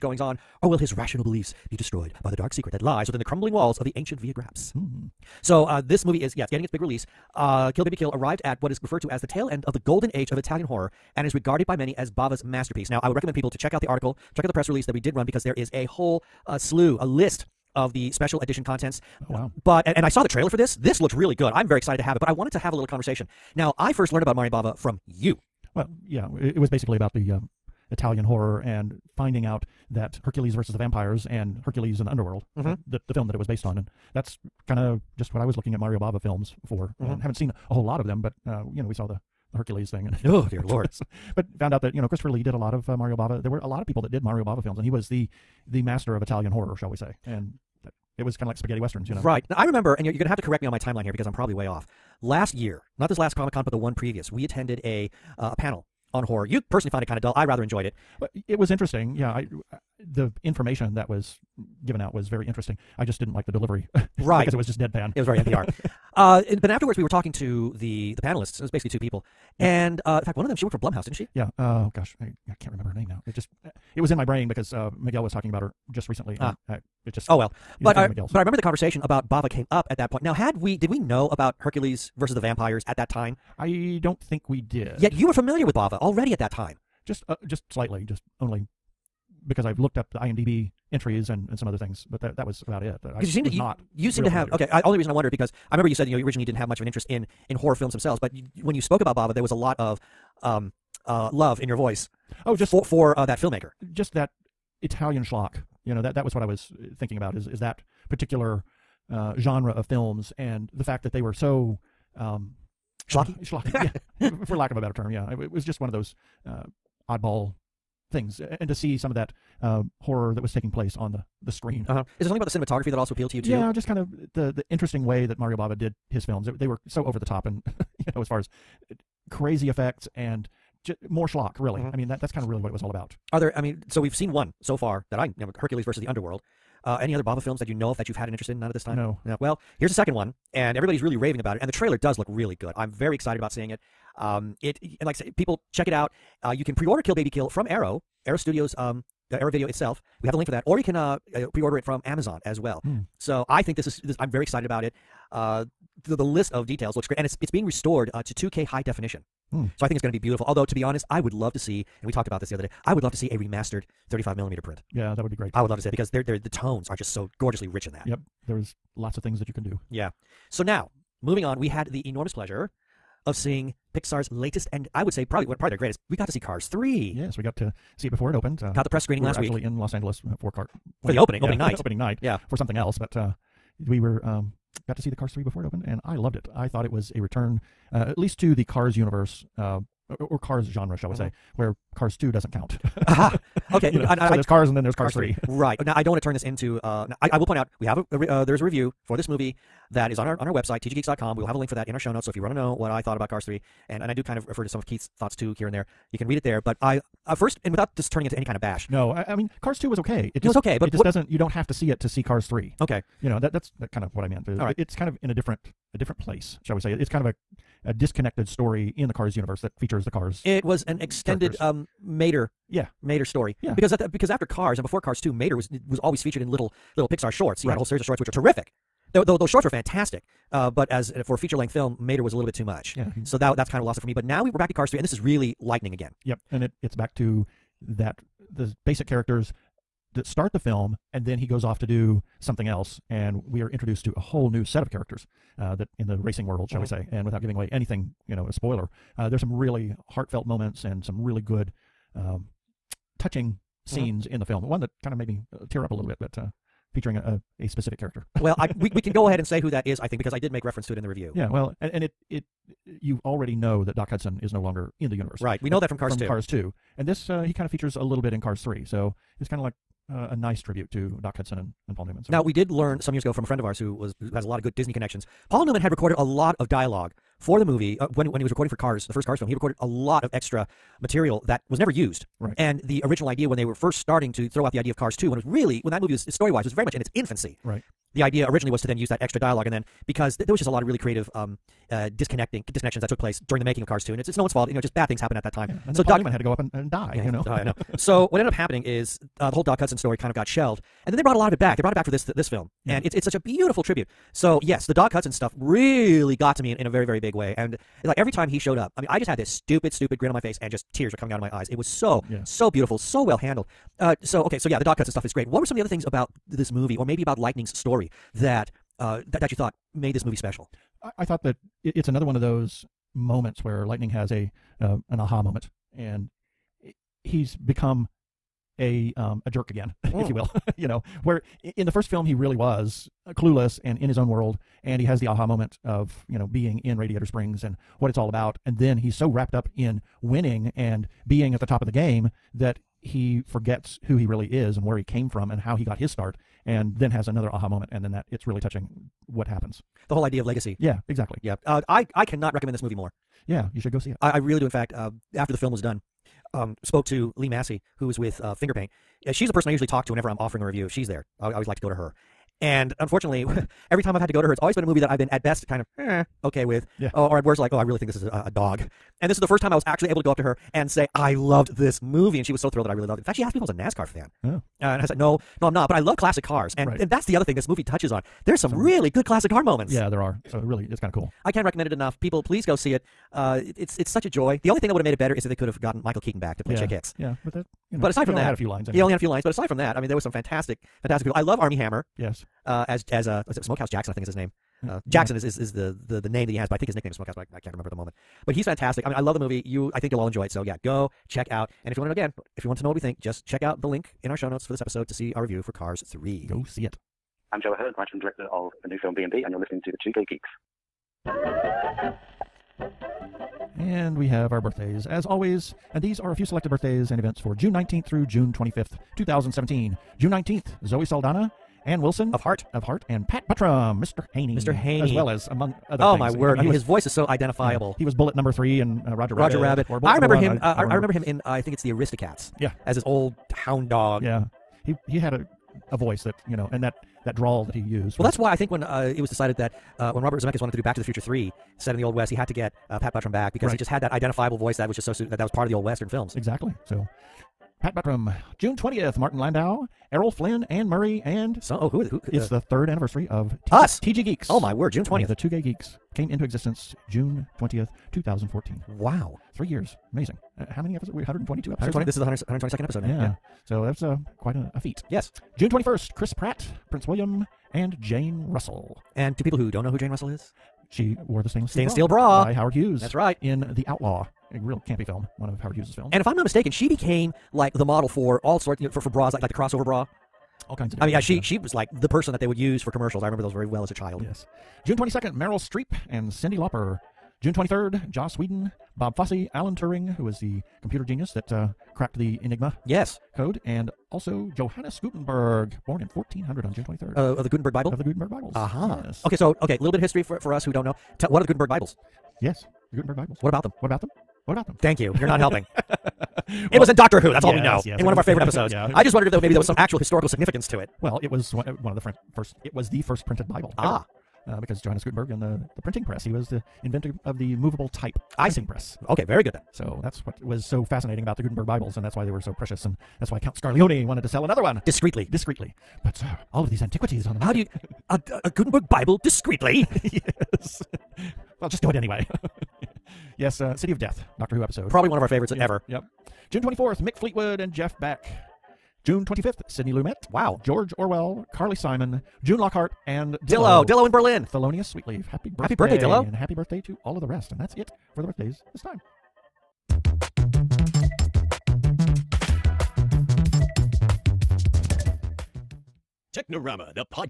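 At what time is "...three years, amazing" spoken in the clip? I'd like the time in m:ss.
7:39.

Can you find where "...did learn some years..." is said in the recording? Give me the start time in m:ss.
4:32.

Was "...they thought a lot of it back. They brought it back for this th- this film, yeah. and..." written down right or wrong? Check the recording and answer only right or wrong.
wrong.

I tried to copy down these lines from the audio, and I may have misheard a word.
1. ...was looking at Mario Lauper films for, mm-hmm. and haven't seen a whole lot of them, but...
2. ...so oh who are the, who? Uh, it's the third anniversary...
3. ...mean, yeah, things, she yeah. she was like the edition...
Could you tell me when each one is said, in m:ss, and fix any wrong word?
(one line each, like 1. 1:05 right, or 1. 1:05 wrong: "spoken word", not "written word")
1. 0:35 wrong: "Bava", not "Lauper"
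2. 7:31 right
3. 8:01 wrong: "person", not "edition".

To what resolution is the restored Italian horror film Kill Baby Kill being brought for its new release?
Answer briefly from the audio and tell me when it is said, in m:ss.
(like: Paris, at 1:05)
2K, at 2:38.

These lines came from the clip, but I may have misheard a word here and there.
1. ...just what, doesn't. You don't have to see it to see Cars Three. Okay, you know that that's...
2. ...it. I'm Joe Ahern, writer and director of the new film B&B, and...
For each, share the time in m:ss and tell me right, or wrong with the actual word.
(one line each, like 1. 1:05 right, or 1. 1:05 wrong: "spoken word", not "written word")
1. 3:30 right
2. 6:46 right.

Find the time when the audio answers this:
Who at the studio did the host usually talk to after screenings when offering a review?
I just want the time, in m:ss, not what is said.
5:57.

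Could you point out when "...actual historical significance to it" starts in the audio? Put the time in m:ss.
8:29.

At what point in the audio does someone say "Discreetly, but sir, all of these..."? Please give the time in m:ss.
8:45.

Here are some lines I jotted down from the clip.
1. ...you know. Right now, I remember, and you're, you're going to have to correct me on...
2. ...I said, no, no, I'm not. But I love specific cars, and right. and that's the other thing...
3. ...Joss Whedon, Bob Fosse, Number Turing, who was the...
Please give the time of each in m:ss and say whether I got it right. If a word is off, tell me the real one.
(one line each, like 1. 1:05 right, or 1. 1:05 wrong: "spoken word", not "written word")
1. 0:49 right
2. 6:15 wrong: "classic", not "specific"
3. 8:08 wrong: "Alan", not "Number".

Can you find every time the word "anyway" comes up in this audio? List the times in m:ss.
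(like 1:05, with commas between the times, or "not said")
6:28, 8:51.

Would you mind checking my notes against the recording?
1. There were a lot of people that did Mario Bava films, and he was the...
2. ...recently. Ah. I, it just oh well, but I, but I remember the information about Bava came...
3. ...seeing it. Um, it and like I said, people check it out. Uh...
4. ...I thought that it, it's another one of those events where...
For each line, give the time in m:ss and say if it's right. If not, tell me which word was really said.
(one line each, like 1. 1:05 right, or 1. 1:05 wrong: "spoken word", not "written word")
1. 0:43 right
2. 1:16 wrong: "conversation", not "information"
3. 2:23 right
4. 5:21 wrong: "moments", not "events".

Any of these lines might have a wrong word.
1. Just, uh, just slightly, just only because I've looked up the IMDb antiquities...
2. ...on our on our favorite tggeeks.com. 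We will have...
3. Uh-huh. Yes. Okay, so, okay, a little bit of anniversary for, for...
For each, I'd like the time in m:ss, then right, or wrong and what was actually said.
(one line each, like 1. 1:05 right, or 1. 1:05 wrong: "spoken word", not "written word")
1. 1:27 wrong: "entries", not "antiquities"
2. 3:20 wrong: "website", not "favorite"
3. 8:18 wrong: "history", not "anniversary".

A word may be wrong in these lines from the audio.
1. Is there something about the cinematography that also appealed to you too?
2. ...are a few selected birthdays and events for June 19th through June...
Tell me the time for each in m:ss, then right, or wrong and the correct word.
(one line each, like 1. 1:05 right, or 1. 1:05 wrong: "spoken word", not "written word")
1. 2:02 right
2. 6:56 right.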